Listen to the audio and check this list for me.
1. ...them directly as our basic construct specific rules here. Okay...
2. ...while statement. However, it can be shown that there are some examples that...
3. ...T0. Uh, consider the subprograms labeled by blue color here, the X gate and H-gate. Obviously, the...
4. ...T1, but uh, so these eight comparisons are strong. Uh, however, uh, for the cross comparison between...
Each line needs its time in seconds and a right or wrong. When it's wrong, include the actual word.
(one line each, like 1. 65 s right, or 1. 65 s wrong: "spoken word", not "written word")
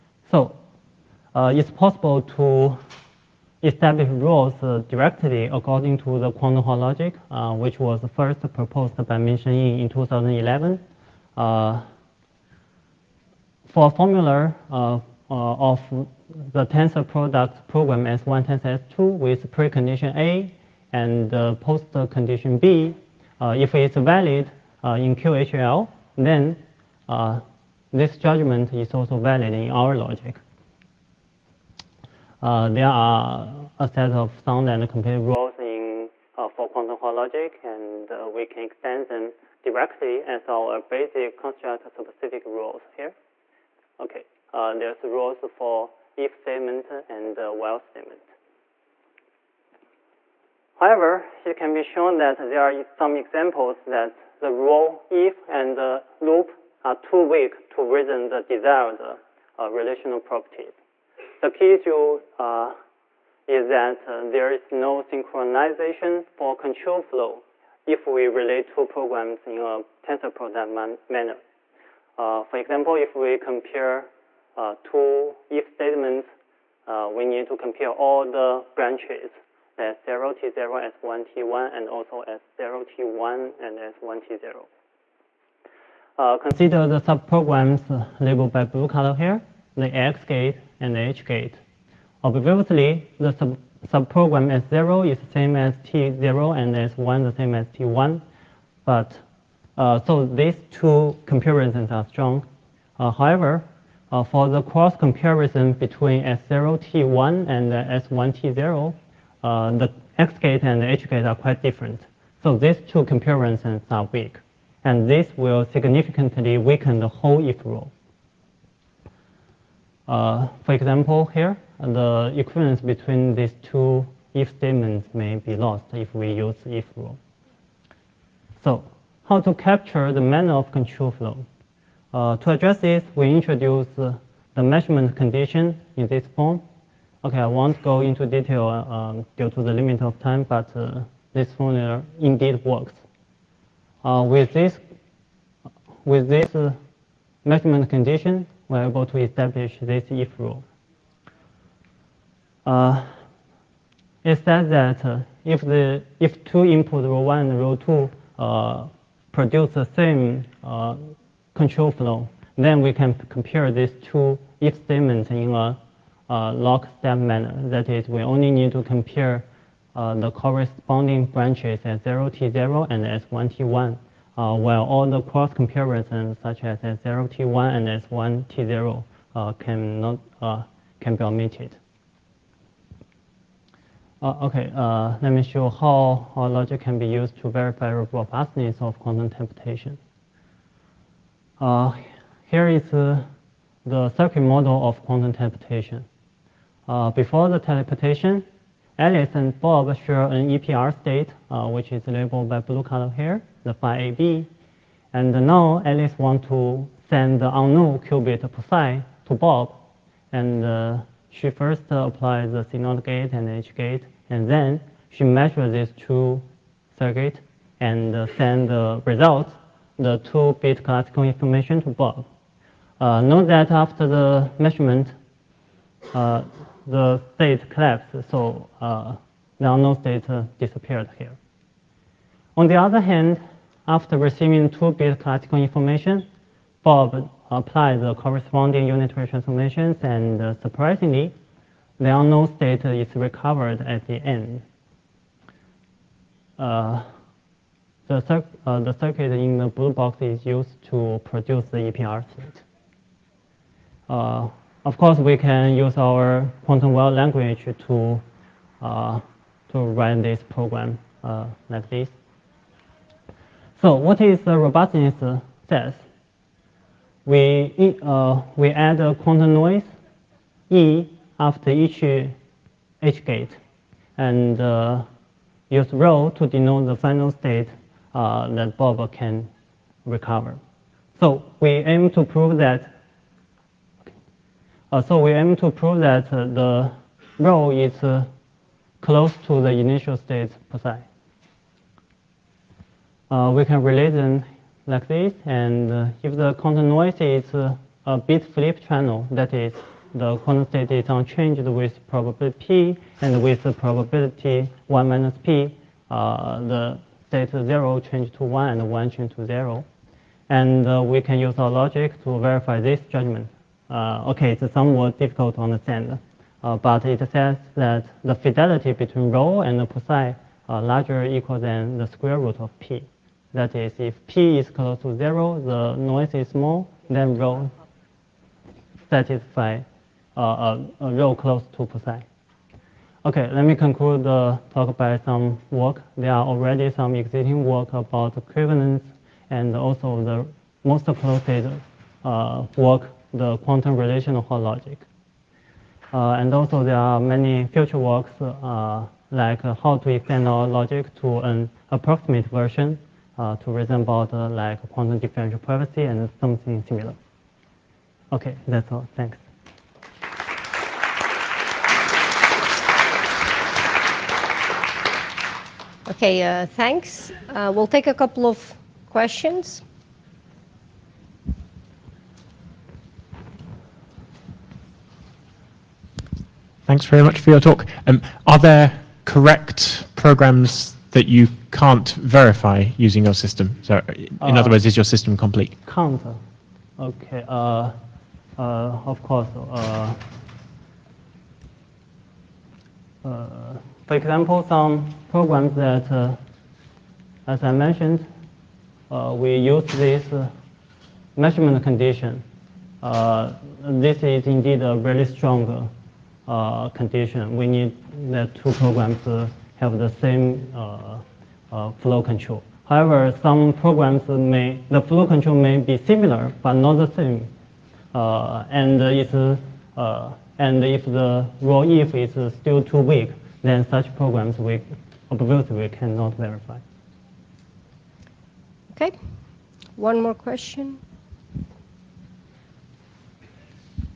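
1. 39 s right
2. 47 s right
3. 84 s right
4. 97 s wrong: "two", not "eight".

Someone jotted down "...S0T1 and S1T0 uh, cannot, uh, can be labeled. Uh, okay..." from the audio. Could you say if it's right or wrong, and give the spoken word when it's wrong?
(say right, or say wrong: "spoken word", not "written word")
wrong: "omitted", not "labeled".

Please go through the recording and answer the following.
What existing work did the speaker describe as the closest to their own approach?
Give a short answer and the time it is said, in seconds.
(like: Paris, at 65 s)
quantum relational logic, at 343 s.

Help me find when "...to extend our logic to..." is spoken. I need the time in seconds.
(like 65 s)
350 s.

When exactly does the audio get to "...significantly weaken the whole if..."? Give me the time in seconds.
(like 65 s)
115 s.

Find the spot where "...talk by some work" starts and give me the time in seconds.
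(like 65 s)
334 s.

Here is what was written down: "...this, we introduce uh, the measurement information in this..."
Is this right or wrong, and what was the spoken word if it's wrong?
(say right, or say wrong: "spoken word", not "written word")
wrong: "condition", not "information".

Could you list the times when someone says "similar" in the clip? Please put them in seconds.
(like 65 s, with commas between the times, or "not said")
356 s, 416 s.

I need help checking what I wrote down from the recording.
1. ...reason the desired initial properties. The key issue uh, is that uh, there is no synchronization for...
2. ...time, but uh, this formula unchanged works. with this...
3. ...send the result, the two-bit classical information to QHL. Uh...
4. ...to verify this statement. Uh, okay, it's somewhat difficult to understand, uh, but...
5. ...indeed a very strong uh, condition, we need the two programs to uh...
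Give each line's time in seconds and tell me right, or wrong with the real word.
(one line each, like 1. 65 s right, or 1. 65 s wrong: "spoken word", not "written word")
1. 57 s wrong: "relational", not "initial"
2. 140 s wrong: "indeed", not "unchanged"
3. 218 s wrong: "Bob", not "QHL"
4. 312 s wrong: "judgment", not "statement"
5. 404 s right.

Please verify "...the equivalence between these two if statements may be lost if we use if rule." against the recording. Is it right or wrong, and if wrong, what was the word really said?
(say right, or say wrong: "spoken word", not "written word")
right.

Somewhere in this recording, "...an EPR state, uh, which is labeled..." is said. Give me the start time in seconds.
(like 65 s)
200 s.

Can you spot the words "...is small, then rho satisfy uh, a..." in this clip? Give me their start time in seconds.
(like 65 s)
326 s.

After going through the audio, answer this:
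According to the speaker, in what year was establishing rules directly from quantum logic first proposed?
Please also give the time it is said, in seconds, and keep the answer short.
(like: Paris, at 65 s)
2011, at 9 s.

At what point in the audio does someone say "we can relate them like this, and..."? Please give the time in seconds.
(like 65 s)
293 s.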